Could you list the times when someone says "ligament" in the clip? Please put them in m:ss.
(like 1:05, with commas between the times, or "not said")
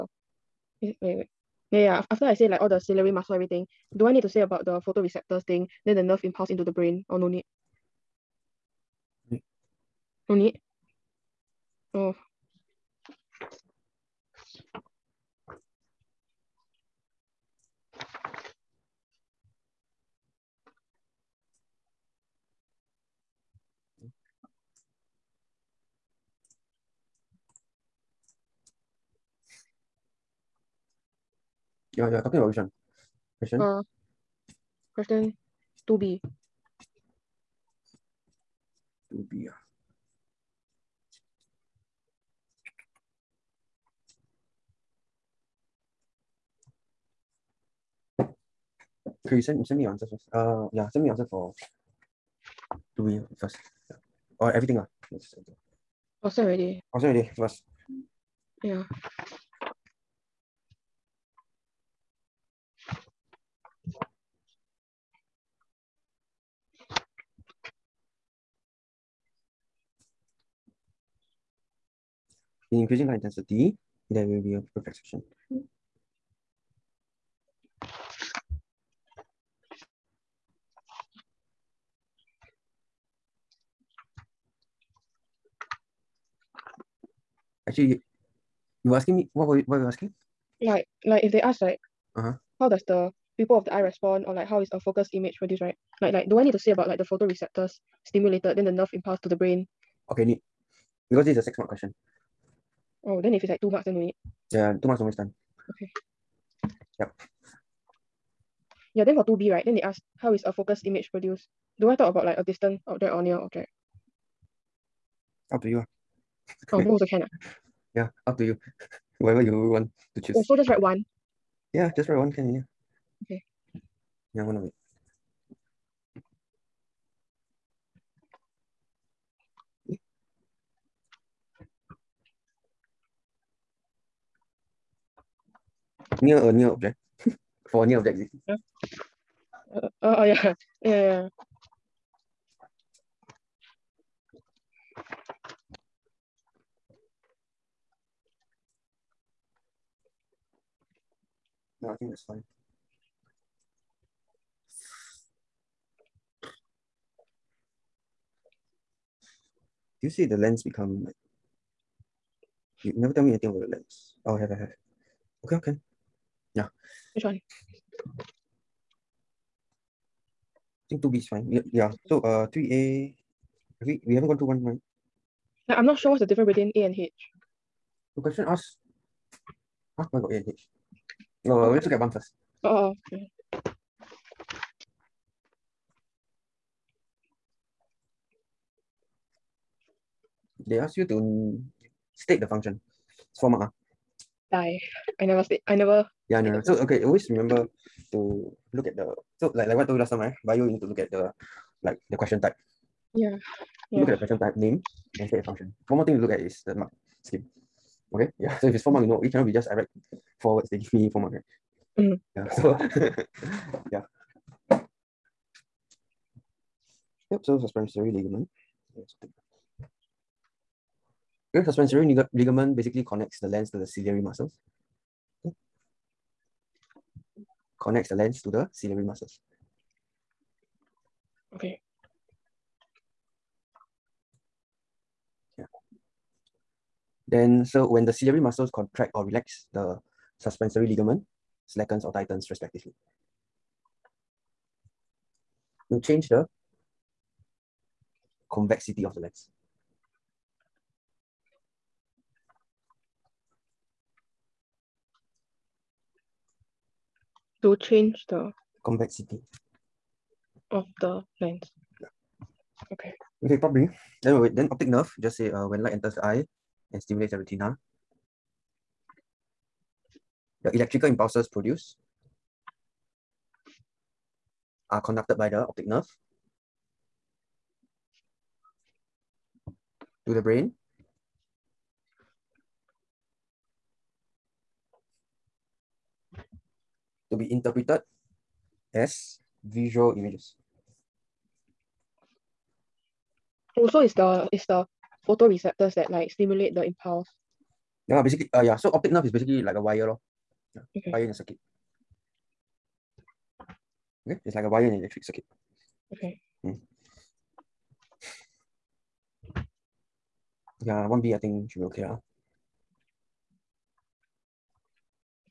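3:38, 3:42, 4:00.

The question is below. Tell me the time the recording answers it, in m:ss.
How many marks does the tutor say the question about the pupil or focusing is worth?
1:41.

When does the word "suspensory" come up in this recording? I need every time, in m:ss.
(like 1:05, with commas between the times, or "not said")
3:37, 3:41, 4:00.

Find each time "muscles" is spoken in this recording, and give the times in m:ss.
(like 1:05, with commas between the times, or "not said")
0:03, 3:44, 3:49, 3:58.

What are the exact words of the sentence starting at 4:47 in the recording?
to be interpreted as visual images.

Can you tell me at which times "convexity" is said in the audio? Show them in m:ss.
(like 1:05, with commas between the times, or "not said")
4:08, 4:18.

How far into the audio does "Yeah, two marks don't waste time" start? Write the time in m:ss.
1:44.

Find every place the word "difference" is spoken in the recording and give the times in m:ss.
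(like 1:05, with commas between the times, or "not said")
2:56.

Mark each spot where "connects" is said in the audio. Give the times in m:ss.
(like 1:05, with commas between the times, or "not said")
3:43, 3:47.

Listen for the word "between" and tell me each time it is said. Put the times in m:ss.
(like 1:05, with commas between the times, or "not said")
2:56.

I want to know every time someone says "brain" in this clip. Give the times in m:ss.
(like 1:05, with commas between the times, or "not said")
0:06, 1:39, 4:40.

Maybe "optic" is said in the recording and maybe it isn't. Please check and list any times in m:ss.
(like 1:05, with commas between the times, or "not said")
4:24, 4:35, 4:58.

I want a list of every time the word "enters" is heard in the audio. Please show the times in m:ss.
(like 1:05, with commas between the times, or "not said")
4:25.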